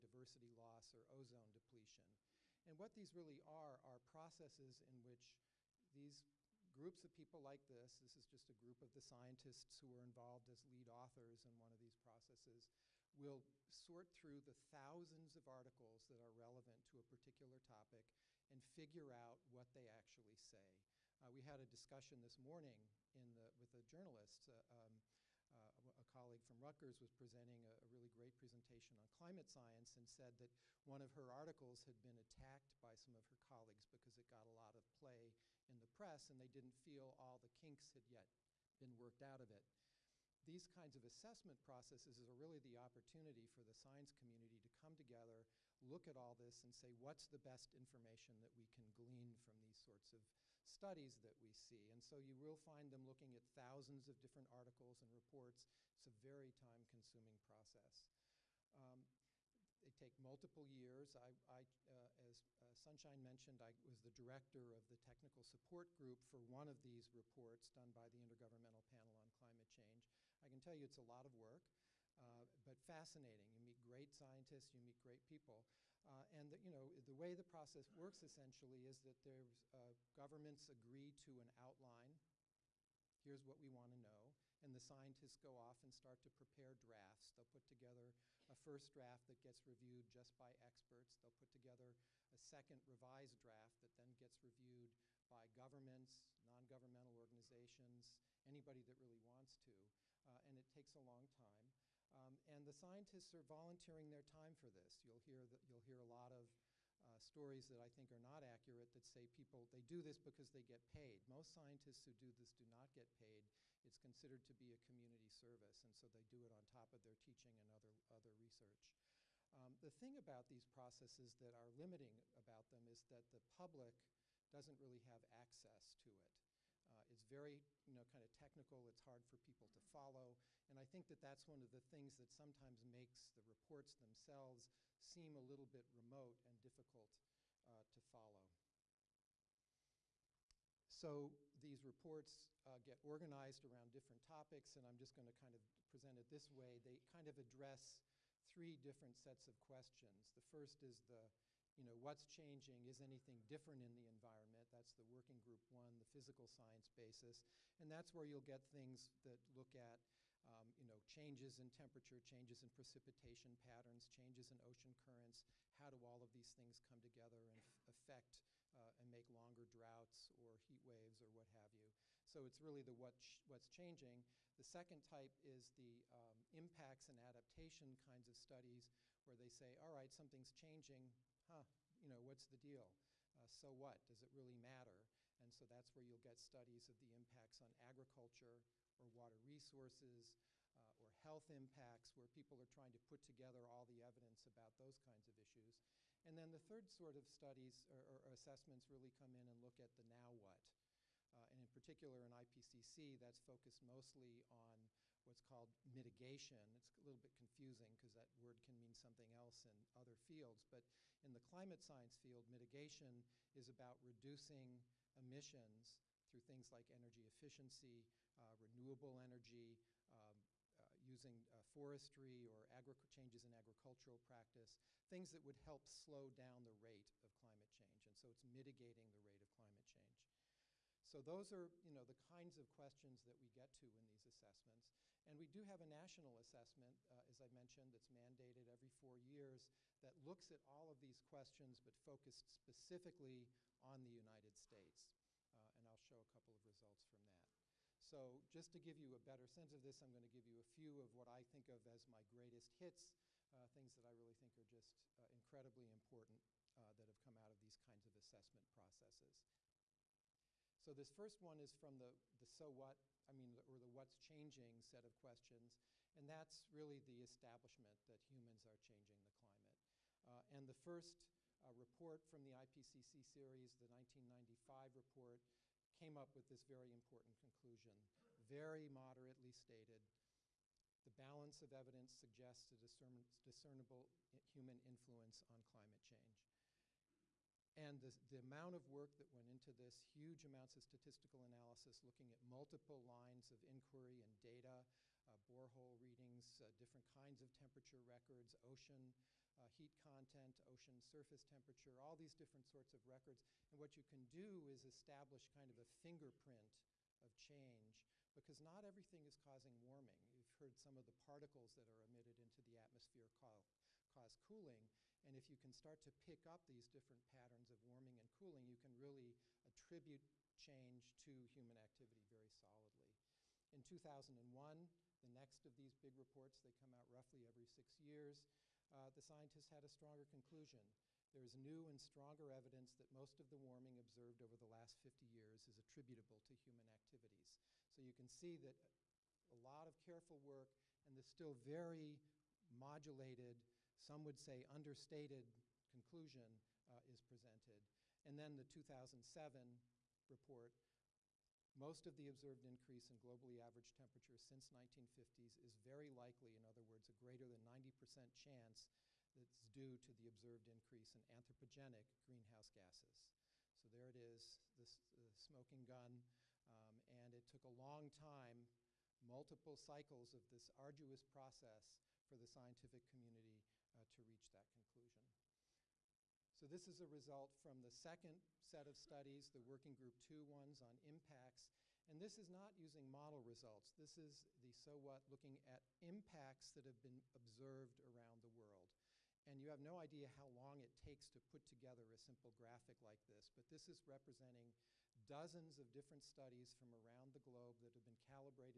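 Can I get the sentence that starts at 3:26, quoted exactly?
It's a little bit confusing because that word can mean something else in other fields.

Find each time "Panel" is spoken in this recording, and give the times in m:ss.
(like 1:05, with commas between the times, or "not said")
1:08.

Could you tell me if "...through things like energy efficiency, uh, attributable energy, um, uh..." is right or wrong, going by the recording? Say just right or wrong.
wrong.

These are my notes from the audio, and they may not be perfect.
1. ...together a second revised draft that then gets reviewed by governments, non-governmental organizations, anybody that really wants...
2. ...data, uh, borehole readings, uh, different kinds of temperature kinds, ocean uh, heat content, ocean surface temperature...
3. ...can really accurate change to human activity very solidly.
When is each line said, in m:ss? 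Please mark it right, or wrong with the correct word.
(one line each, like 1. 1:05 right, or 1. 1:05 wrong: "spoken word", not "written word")
1. 1:31 right
2. 4:54 wrong: "records", not "kinds"
3. 5:18 wrong: "attribute", not "accurate".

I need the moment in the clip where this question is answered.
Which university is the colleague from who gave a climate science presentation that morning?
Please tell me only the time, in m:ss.
0:26.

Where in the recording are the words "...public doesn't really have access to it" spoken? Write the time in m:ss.
2:03.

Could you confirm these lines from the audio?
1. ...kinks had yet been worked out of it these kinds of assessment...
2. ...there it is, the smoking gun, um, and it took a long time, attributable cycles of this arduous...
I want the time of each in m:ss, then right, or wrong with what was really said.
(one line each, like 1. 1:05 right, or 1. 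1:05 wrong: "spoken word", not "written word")
1. 0:37 right
2. 6:03 wrong: "multiple", not "attributable".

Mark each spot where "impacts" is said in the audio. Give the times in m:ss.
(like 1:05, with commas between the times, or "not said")
2:56, 3:07, 3:11, 6:21, 6:26.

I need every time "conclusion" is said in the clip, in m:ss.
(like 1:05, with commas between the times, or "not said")
4:37, 5:30, 5:45, 6:14.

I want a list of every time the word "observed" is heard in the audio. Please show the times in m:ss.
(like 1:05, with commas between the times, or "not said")
5:33, 5:52, 6:00, 6:27.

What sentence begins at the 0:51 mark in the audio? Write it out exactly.
And so you will find them looking at thousands of different articles and reports.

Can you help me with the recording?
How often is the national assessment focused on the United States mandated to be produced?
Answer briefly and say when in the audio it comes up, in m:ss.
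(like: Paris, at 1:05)
every 4 years, at 3:58.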